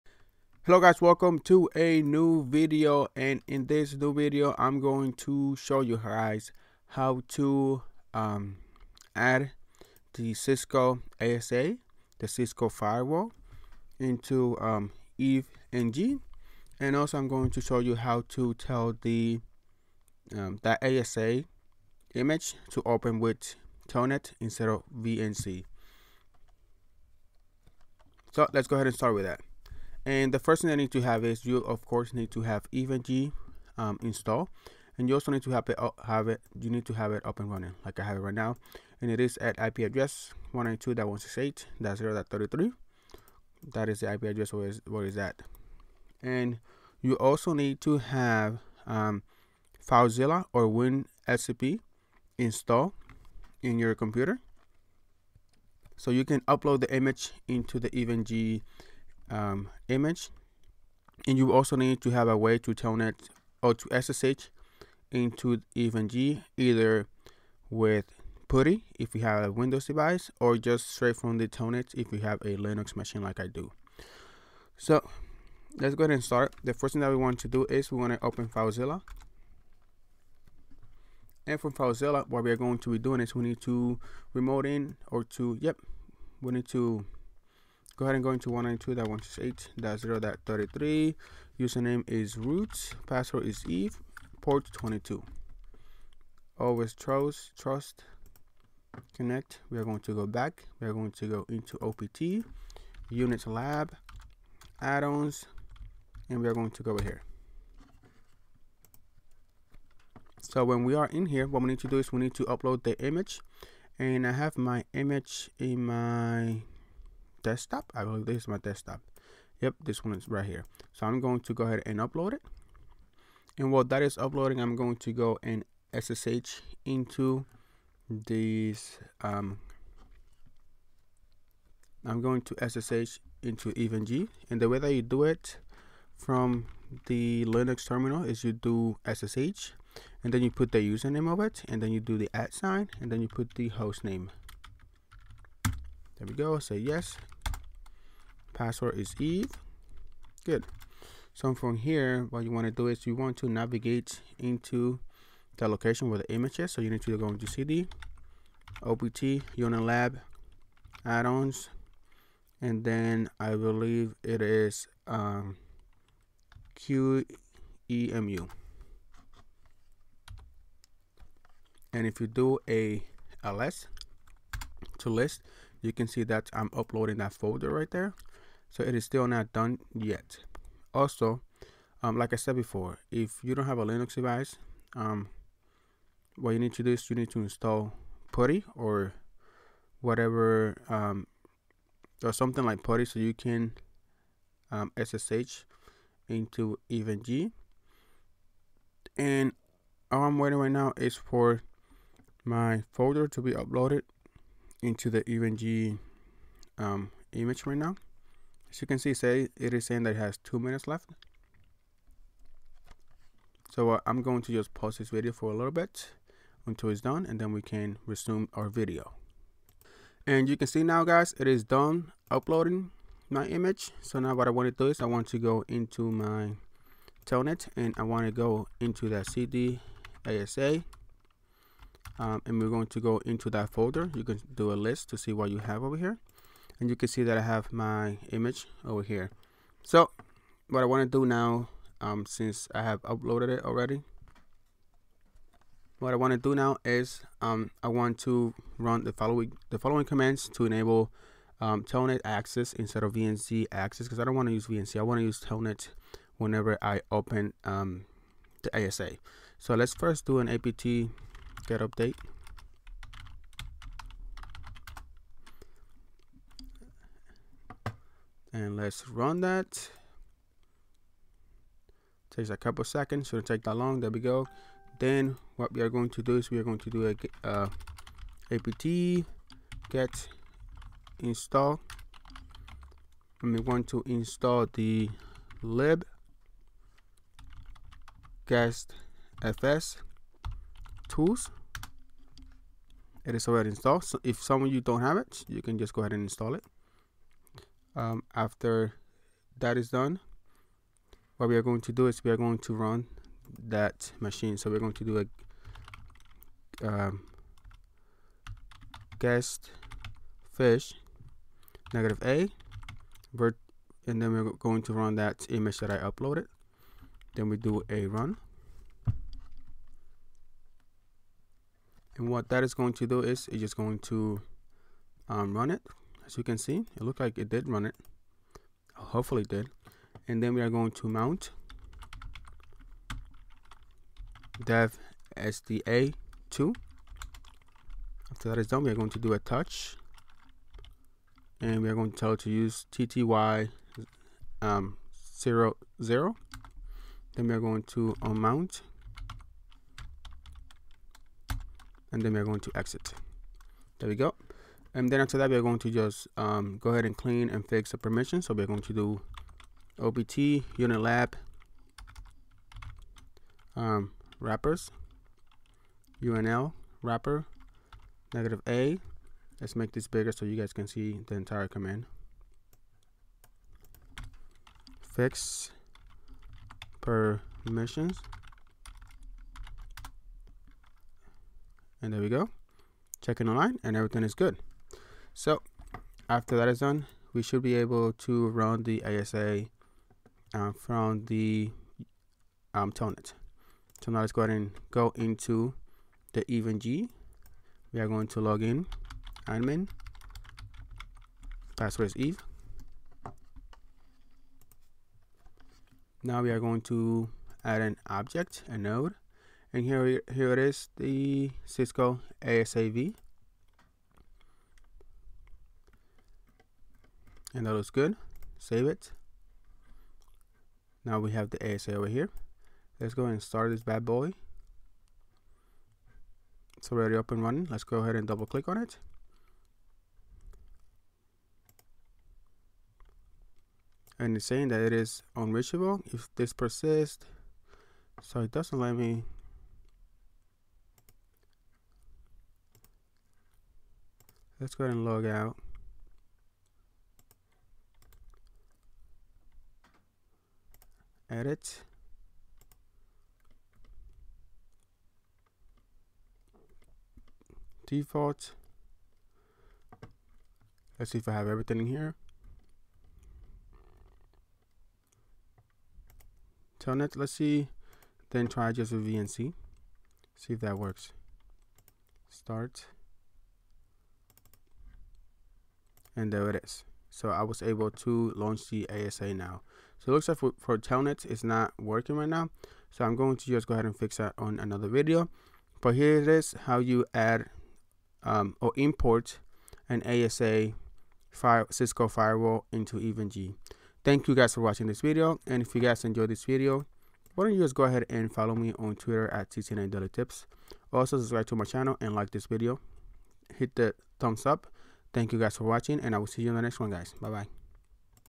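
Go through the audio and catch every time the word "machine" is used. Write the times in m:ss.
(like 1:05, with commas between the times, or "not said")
1:12, 5:04.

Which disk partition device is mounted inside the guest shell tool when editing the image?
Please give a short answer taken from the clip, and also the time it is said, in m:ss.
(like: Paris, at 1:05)
/dev/sda2, at 5:34.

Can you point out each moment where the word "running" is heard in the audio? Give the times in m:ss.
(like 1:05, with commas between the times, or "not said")
0:37, 7:07.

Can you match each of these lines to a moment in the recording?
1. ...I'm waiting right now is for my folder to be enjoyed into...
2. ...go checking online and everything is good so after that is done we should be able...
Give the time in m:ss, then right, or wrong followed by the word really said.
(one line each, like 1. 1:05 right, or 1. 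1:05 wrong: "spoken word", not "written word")
1. 3:20 wrong: "uploaded", not "enjoyed"
2. 6:22 right.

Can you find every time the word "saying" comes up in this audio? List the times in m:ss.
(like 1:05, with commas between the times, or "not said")
3:29, 7:14.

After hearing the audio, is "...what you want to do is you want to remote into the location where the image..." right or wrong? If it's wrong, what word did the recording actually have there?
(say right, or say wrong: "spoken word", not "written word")
wrong: "navigate", not "remote".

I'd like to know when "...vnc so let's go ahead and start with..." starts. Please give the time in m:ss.
0:24.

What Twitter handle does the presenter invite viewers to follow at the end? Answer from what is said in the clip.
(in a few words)
TT9 Tips.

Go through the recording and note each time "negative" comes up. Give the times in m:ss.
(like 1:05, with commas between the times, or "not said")
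5:11, 6:08.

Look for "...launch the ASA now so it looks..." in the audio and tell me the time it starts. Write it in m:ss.
7:58.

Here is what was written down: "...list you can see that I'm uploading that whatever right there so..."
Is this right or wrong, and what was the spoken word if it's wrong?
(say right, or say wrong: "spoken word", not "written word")
wrong: "folder", not "whatever".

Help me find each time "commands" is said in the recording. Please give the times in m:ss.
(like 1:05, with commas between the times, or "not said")
4:10, 6:11.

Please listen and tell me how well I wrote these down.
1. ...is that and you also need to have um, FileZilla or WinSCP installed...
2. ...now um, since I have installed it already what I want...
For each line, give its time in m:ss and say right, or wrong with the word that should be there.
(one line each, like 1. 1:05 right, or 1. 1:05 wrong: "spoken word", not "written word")
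1. 0:45 right
2. 4:01 wrong: "uploaded", not "installed".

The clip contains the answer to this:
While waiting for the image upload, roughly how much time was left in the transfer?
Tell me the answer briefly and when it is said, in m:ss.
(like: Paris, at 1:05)
two minutes, at 3:30.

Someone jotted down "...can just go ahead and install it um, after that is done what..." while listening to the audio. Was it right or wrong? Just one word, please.
right.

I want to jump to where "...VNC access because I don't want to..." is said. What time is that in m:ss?
4:13.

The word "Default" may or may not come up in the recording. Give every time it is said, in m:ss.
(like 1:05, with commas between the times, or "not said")
7:37.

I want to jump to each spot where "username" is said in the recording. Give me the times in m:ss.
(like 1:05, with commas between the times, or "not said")
1:31, 2:20.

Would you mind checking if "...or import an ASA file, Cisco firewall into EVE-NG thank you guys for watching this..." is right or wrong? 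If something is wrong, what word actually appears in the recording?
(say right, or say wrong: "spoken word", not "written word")
right.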